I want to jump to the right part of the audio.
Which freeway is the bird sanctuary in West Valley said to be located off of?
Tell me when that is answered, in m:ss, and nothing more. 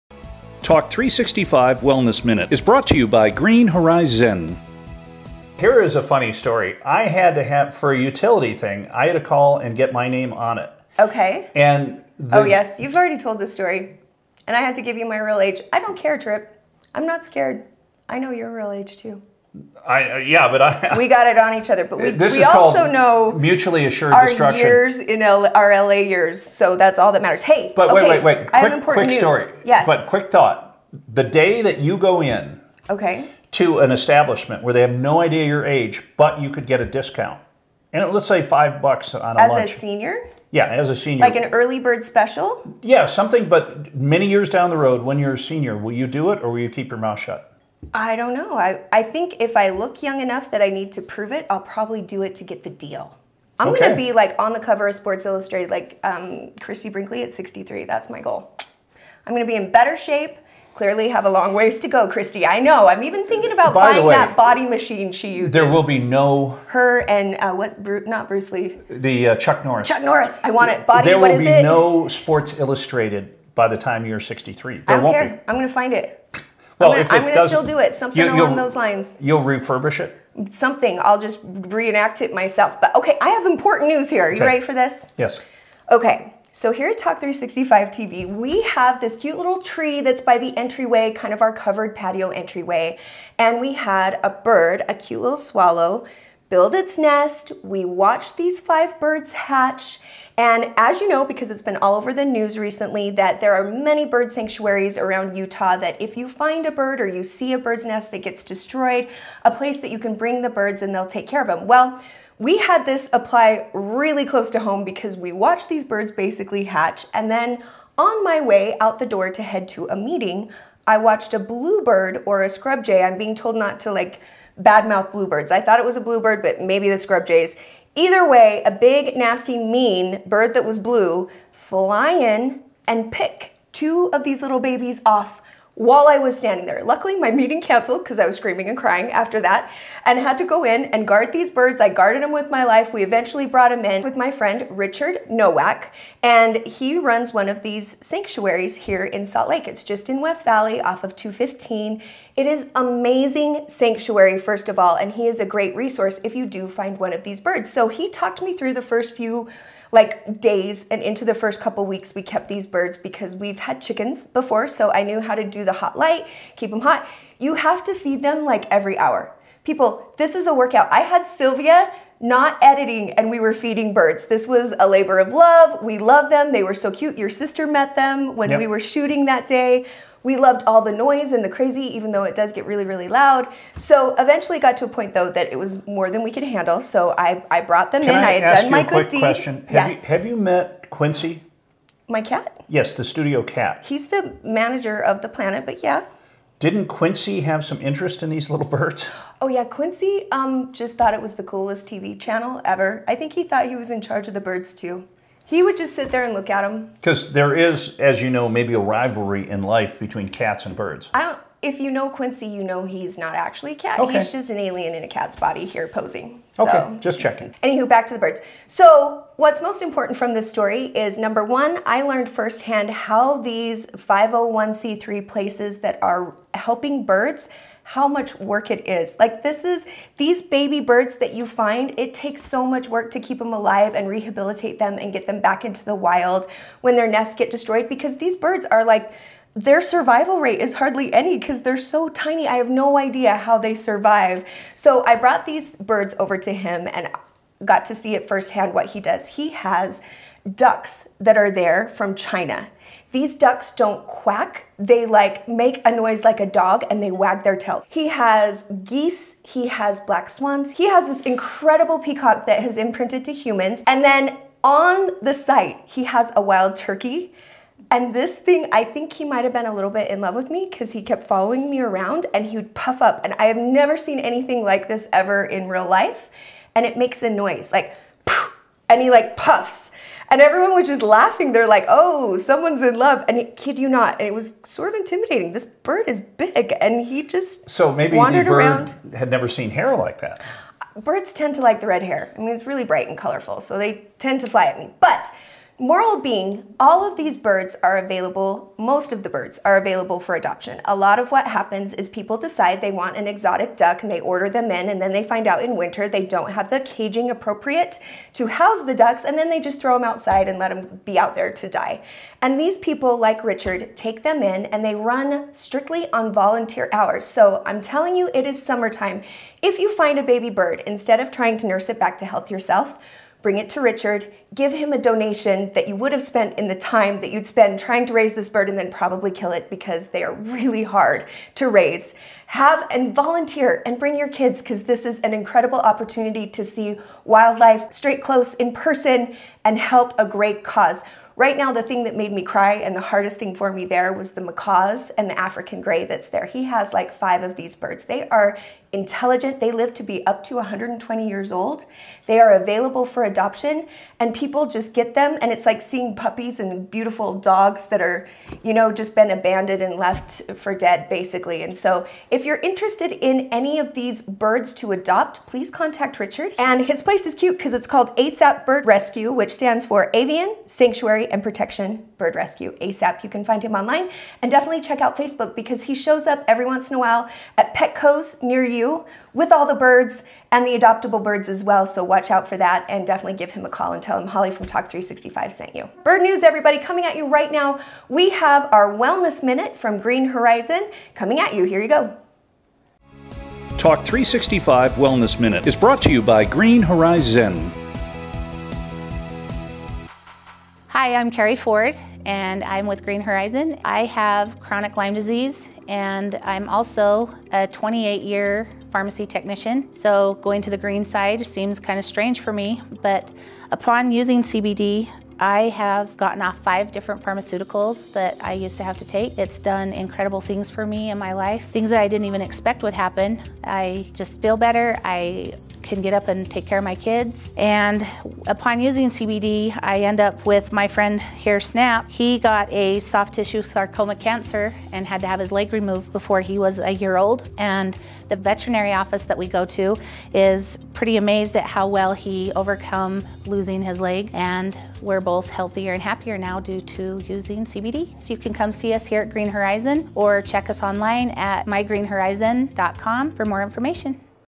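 2:31.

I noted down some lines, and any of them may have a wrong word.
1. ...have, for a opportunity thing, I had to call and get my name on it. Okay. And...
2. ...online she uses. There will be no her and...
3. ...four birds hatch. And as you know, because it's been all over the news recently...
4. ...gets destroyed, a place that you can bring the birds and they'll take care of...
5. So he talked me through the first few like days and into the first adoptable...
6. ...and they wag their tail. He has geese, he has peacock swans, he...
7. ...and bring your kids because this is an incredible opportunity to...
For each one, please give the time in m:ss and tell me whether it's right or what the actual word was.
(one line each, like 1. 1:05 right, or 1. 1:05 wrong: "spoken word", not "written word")
1. 0:07 wrong: "utility", not "opportunity"
2. 1:04 wrong: "machine", not "online"
3. 1:38 wrong: "five", not "four"
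4. 1:48 right
5. 2:37 wrong: "couple", not "adoptable"
6. 4:16 wrong: "black", not "peacock"
7. 5:33 right.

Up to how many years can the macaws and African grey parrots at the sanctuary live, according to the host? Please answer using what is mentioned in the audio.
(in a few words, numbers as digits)
120.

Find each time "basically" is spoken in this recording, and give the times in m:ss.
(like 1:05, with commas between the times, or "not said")
1:56, 6:01.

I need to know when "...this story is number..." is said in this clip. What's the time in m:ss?
3:40.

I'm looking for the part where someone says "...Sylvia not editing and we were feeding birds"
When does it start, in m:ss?
2:51.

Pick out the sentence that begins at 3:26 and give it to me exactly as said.
Because there is, as you know, maybe a rivalry in life between cats and birds.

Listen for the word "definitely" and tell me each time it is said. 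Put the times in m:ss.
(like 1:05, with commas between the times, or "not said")
6:14, 6:23.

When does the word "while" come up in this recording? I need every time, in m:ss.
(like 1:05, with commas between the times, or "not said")
2:15, 6:16.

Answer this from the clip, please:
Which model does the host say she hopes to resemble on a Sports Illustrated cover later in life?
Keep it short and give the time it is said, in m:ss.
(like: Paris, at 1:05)
Christie Brinkley, at 0:56.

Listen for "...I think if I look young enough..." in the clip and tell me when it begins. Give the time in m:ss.
0:48.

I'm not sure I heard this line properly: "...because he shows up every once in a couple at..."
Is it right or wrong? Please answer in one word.
wrong.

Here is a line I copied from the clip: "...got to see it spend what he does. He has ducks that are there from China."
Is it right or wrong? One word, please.
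wrong.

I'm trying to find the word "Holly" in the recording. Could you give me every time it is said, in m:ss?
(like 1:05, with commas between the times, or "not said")
6:24.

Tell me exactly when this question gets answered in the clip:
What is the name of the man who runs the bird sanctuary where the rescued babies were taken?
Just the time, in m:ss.
2:24.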